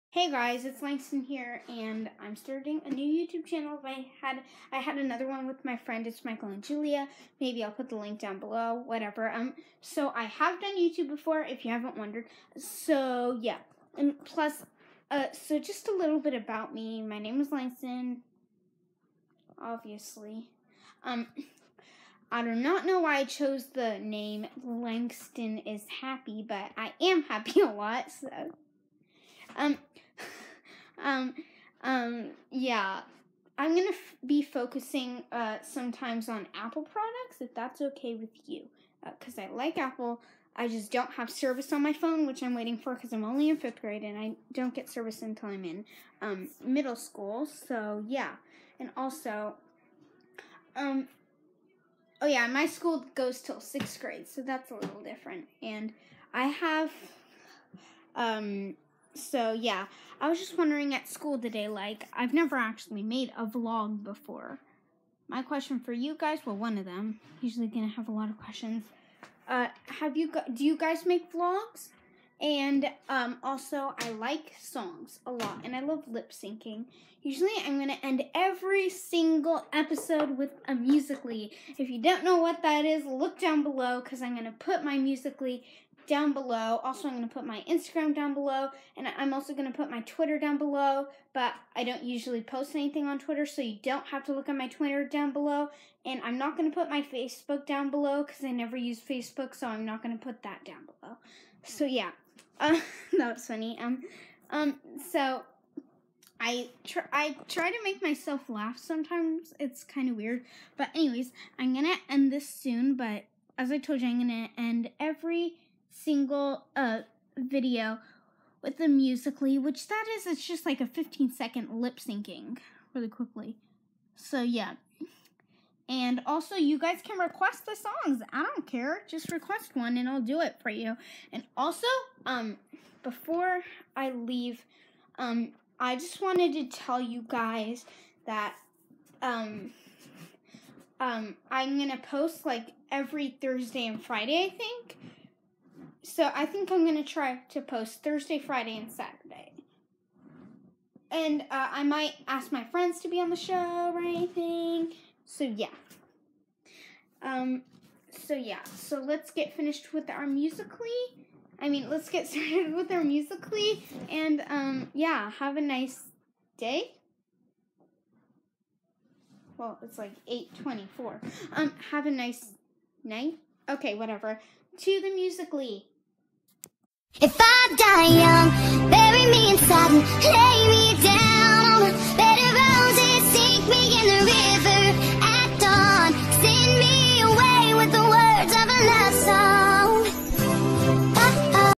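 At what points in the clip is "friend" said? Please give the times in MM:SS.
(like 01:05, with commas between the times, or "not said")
00:05, 02:32.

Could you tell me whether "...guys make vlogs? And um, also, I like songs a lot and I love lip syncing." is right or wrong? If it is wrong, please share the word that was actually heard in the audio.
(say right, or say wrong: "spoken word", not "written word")
right.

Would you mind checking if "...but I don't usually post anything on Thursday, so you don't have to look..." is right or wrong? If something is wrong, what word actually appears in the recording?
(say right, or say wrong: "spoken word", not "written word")
wrong: "Twitter", not "Thursday".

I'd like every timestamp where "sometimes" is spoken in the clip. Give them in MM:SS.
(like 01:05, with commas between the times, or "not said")
00:35, 01:48.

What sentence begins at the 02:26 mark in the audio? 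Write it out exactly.
So I think I'm going to try to post Thursday, Friday, and Saturday.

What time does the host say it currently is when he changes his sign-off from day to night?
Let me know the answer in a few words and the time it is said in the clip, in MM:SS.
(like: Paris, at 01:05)
8:24, at 02:50.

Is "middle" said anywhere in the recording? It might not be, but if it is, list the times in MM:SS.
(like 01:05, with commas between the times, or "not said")
00:46.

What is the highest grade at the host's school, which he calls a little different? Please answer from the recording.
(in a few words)
sixth grade.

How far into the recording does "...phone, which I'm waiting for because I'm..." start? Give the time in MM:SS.
00:41.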